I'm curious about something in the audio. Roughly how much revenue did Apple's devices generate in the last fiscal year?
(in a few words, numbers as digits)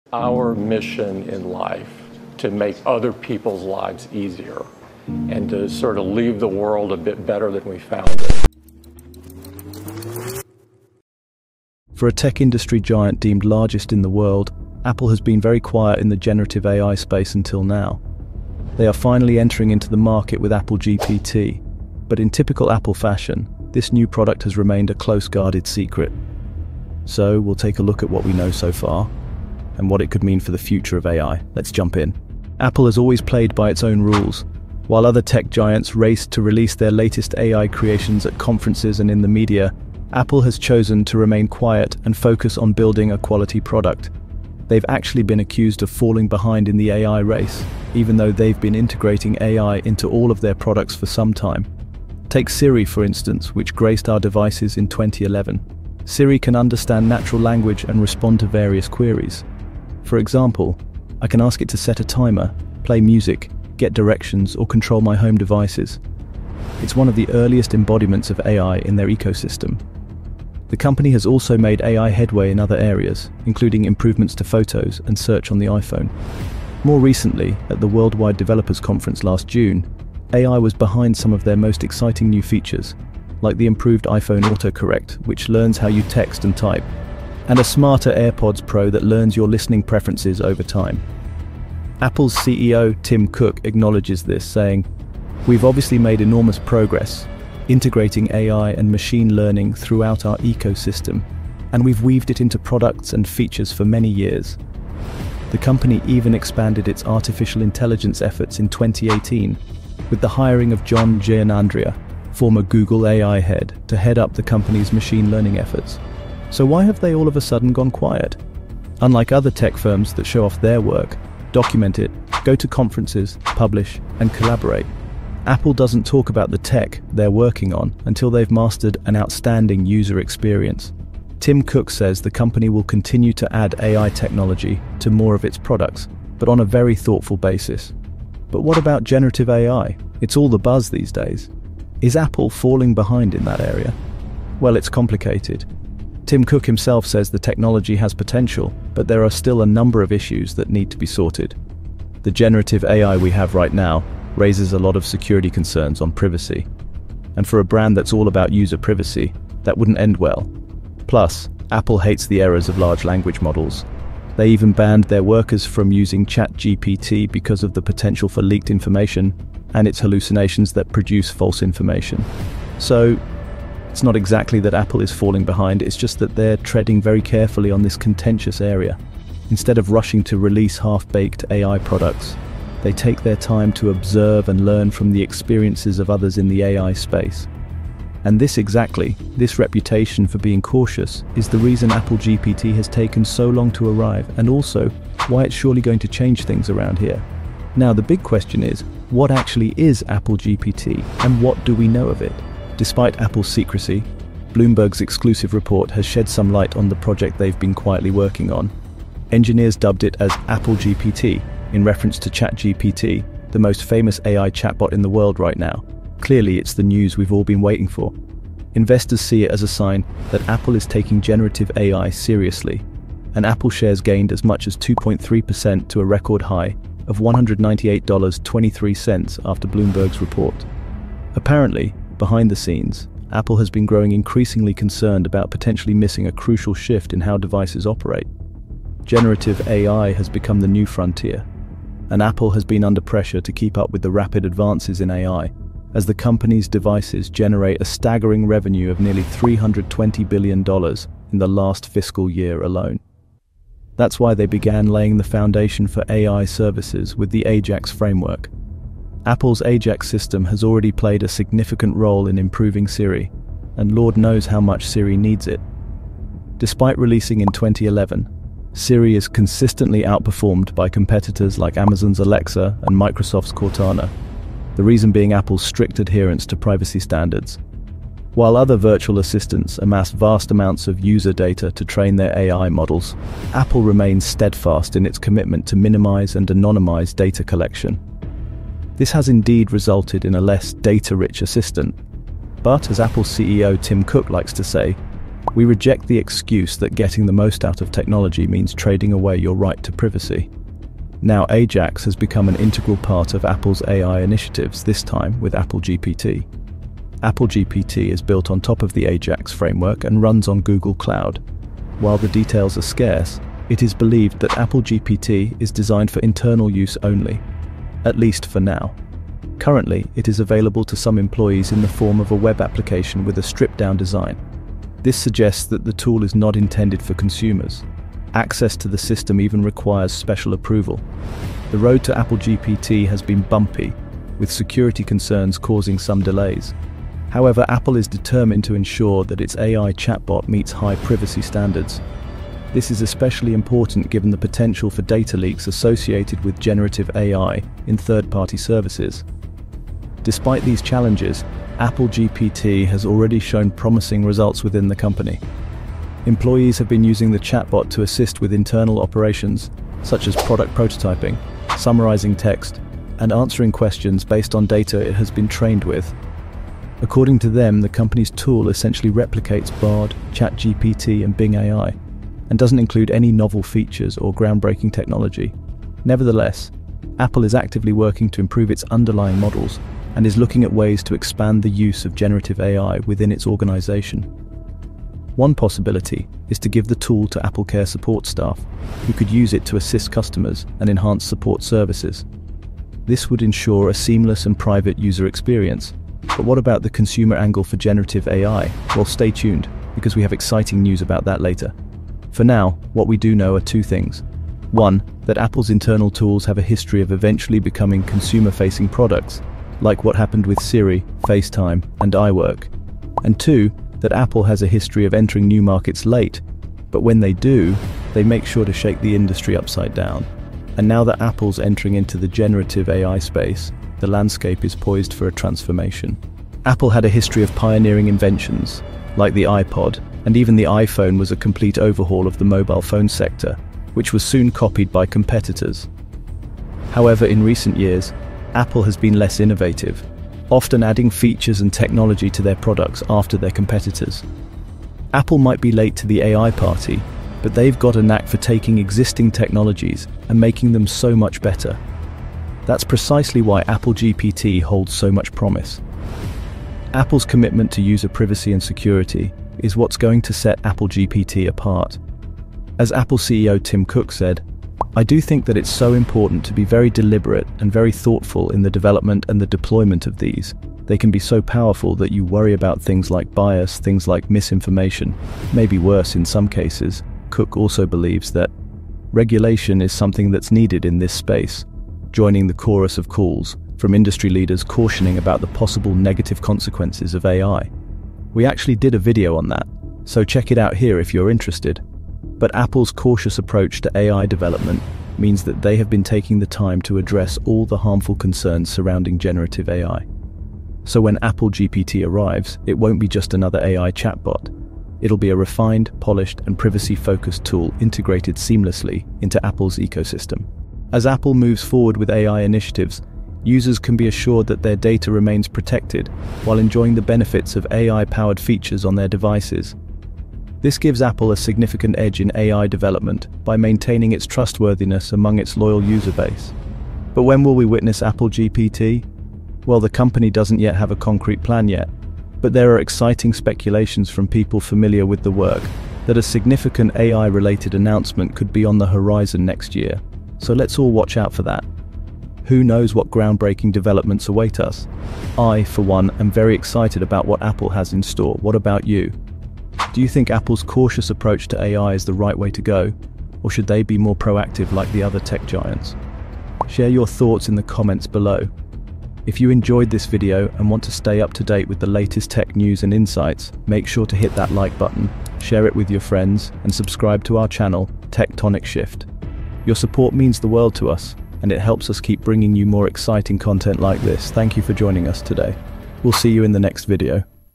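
$320 billion.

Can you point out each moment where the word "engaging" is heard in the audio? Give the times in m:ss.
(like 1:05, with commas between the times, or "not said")
not said.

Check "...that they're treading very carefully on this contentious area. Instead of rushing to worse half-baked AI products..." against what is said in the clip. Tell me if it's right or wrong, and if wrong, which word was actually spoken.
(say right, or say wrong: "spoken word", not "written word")
wrong: "release", not "worse".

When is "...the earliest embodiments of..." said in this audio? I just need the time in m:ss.
1:07.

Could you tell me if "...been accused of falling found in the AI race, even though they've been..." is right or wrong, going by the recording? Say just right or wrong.
wrong.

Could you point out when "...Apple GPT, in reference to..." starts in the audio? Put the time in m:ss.
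3:30.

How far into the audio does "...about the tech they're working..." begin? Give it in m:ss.
2:06.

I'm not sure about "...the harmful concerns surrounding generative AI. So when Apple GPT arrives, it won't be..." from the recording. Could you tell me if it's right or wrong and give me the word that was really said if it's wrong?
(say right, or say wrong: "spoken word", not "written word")
right.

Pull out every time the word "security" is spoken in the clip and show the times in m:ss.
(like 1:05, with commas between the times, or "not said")
2:35, 5:34, 7:38.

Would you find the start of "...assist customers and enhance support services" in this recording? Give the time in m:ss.
6:29.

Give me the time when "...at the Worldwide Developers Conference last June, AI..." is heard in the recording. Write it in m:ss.
1:17.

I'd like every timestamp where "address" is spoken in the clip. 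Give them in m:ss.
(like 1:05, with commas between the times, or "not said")
8:16.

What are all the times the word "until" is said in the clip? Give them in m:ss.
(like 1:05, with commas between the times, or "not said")
0:17, 2:08.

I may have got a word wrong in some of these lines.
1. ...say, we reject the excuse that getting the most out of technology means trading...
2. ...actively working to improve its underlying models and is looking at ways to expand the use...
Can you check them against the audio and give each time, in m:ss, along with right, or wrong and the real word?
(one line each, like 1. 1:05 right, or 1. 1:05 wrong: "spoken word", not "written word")
1. 4:54 right
2. 6:17 right.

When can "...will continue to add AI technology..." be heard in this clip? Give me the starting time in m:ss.
2:12.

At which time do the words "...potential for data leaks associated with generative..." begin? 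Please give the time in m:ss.
5:44.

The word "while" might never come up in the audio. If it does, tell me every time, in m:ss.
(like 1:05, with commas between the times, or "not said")
0:34, 4:38, 5:12, 8:36.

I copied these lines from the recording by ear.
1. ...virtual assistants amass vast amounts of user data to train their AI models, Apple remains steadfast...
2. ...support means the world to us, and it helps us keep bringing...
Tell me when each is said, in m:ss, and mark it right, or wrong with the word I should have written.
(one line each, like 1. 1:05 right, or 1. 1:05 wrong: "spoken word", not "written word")
1. 4:38 right
2. 9:29 right.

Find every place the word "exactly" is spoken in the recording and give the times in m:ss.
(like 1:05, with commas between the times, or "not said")
2:54, 3:08.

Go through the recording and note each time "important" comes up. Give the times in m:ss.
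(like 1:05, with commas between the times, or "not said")
5:43, 7:45.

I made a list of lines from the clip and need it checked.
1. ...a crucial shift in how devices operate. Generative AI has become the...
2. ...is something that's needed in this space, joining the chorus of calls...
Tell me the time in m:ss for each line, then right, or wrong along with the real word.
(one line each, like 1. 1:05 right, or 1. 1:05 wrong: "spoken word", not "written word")
1. 3:56 right
2. 7:59 right.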